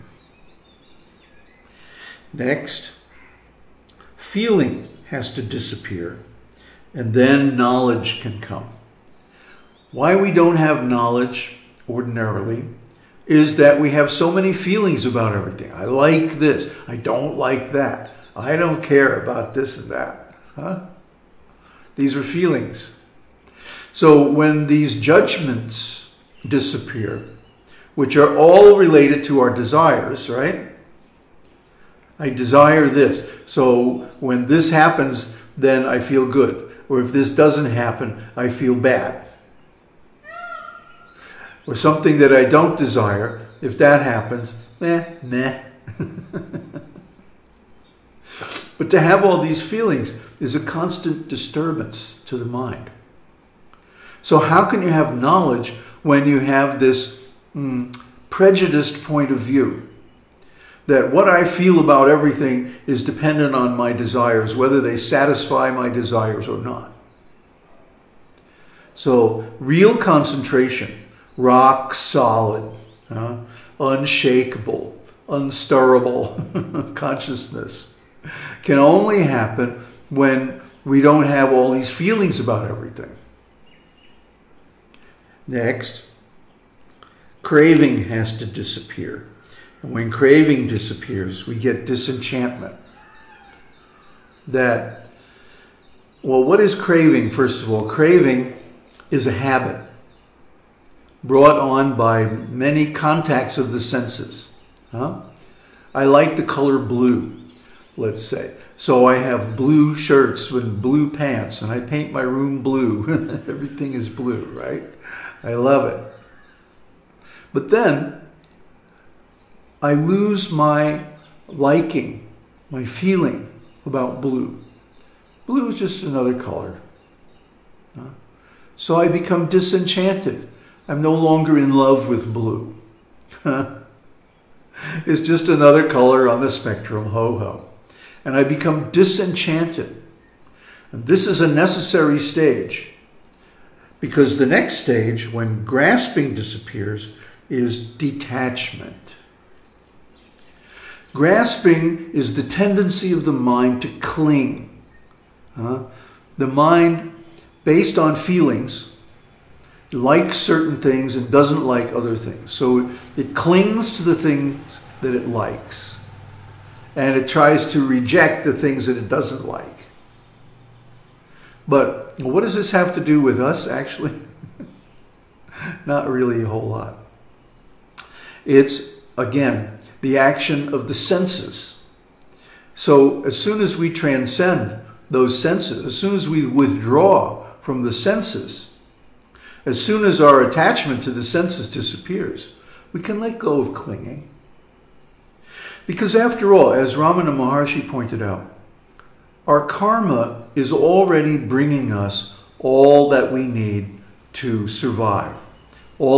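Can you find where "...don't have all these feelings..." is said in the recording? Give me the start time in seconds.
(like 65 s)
81 s.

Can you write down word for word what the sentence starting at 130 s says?
I'm no longer in love with blue.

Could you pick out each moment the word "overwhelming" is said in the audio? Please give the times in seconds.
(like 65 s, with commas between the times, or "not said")
not said.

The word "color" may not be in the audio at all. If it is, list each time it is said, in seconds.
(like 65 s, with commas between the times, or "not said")
106 s, 126 s, 135 s.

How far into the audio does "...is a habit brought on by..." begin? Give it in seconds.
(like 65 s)
99 s.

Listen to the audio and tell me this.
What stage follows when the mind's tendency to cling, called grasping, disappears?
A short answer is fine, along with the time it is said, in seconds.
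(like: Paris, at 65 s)
detachment, at 147 s.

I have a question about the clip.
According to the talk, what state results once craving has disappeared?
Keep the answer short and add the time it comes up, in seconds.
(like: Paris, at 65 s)
disenchantment, at 91 s.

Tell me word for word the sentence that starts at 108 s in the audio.
So I have blue shirts with blue pants, and I paint my room blue.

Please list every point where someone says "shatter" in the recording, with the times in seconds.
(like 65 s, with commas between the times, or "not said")
not said.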